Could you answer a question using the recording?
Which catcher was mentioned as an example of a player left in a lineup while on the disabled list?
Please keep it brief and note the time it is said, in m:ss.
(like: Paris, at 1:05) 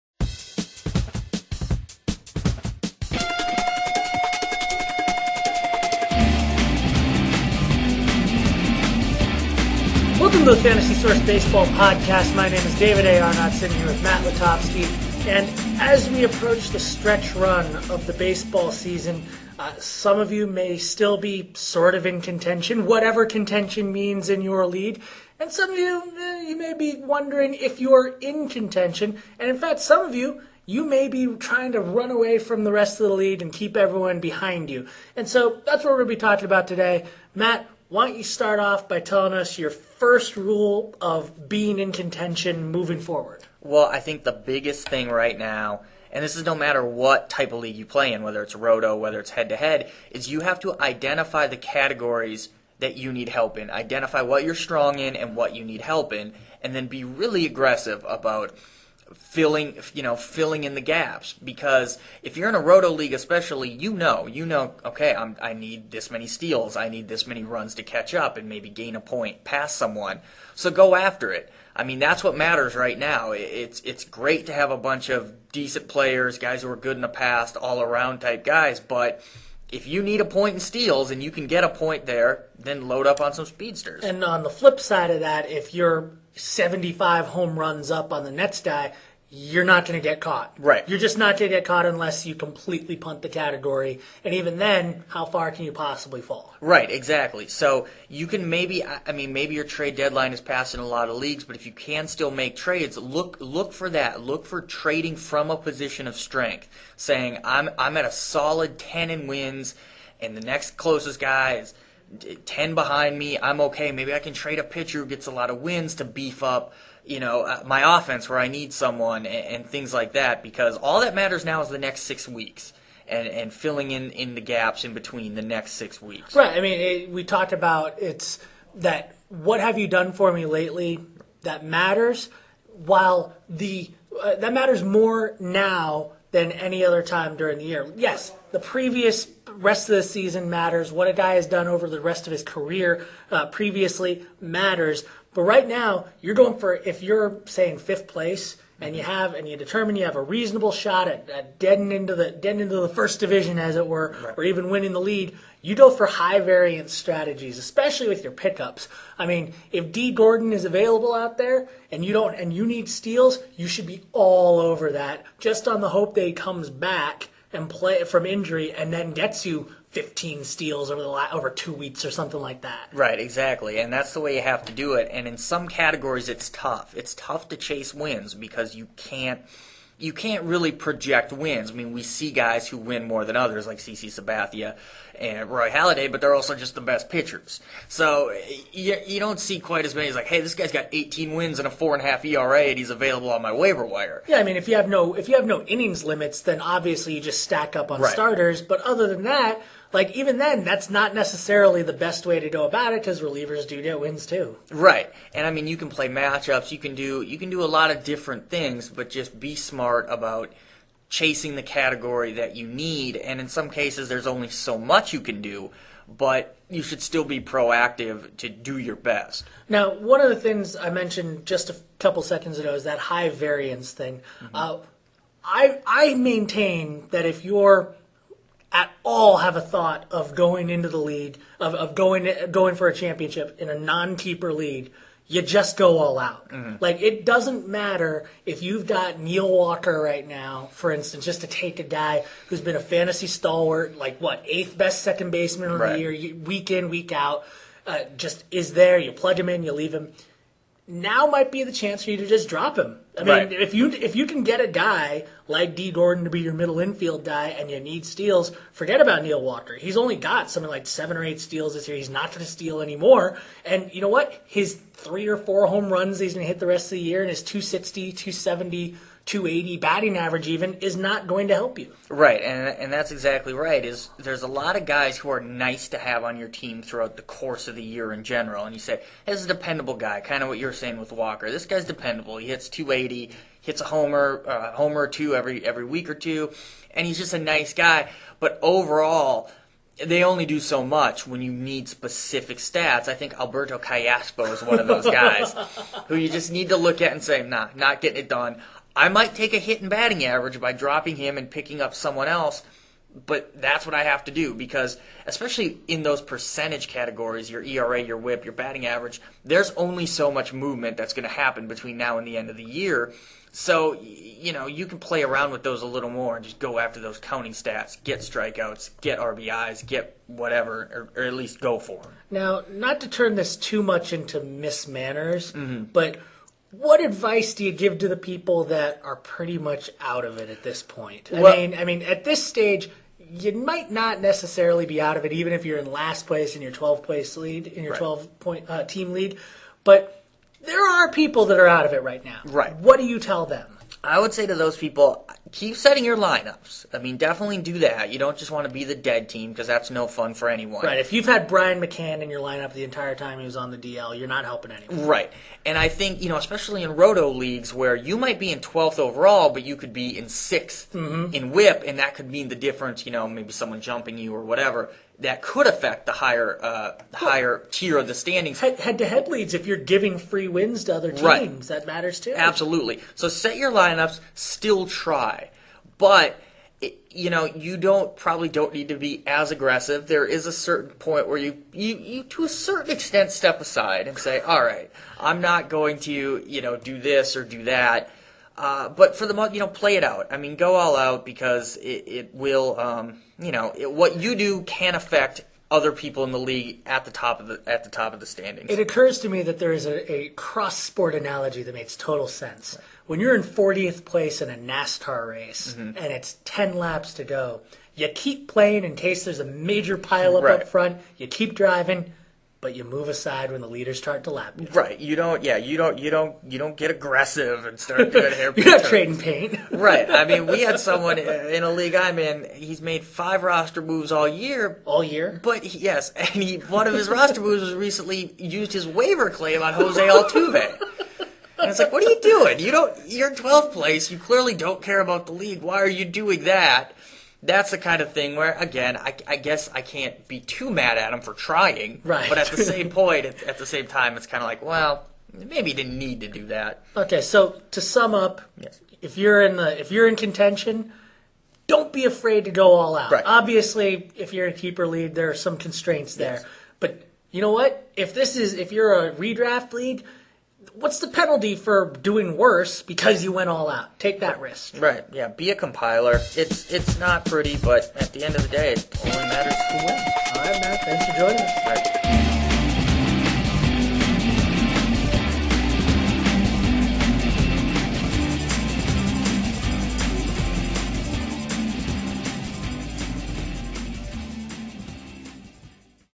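Brian McCann, at 5:51.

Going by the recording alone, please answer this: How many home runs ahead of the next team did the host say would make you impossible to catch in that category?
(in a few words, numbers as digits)
75.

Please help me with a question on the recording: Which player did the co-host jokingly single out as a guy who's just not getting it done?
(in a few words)
Alberto Callaspo.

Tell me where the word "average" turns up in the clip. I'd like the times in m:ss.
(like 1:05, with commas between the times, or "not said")
4:30, 5:00, 5:08.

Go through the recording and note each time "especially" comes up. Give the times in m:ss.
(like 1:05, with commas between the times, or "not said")
1:03, 2:37, 5:05, 5:56.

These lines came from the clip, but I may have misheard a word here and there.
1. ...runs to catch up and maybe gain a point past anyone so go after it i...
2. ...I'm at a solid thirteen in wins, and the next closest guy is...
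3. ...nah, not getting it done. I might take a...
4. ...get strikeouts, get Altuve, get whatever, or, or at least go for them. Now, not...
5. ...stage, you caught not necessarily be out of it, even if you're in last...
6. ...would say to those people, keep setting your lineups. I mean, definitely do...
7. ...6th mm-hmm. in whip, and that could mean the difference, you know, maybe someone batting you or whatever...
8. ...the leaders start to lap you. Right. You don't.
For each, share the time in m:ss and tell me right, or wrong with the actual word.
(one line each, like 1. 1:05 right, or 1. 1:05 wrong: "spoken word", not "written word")
1. 1:07 wrong: "someone", not "anyone"
2. 1:47 wrong: "ten", not "thirteen"
3. 4:57 right
4. 5:18 wrong: "RBIs", not "Altuve"
5. 5:32 wrong: "might", not "caught"
6. 5:44 right
7. 6:00 wrong: "jumping", not "batting"
8. 6:53 right.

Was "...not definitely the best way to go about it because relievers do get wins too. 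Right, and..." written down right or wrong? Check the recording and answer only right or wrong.
wrong.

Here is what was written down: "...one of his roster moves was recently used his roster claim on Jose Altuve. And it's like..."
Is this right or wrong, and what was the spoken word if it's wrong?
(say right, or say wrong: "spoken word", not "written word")
wrong: "waiver", not "roster".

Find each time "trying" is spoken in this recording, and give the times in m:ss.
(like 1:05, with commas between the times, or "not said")
0:31, 7:21.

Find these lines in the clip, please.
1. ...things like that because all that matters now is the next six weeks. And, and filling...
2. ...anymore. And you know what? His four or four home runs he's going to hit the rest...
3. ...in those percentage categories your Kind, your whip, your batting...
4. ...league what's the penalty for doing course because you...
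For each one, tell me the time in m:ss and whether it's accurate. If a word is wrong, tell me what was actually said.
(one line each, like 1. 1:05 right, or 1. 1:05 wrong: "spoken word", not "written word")
1. 1:59 right
2. 4:22 wrong: "three", not "four"
3. 5:05 wrong: "ERA", not "Kind"
4. 7:39 wrong: "worse", not "course".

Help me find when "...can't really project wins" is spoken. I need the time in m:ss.
3:00.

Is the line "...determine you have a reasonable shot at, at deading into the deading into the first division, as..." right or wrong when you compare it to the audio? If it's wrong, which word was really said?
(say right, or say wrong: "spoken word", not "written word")
right.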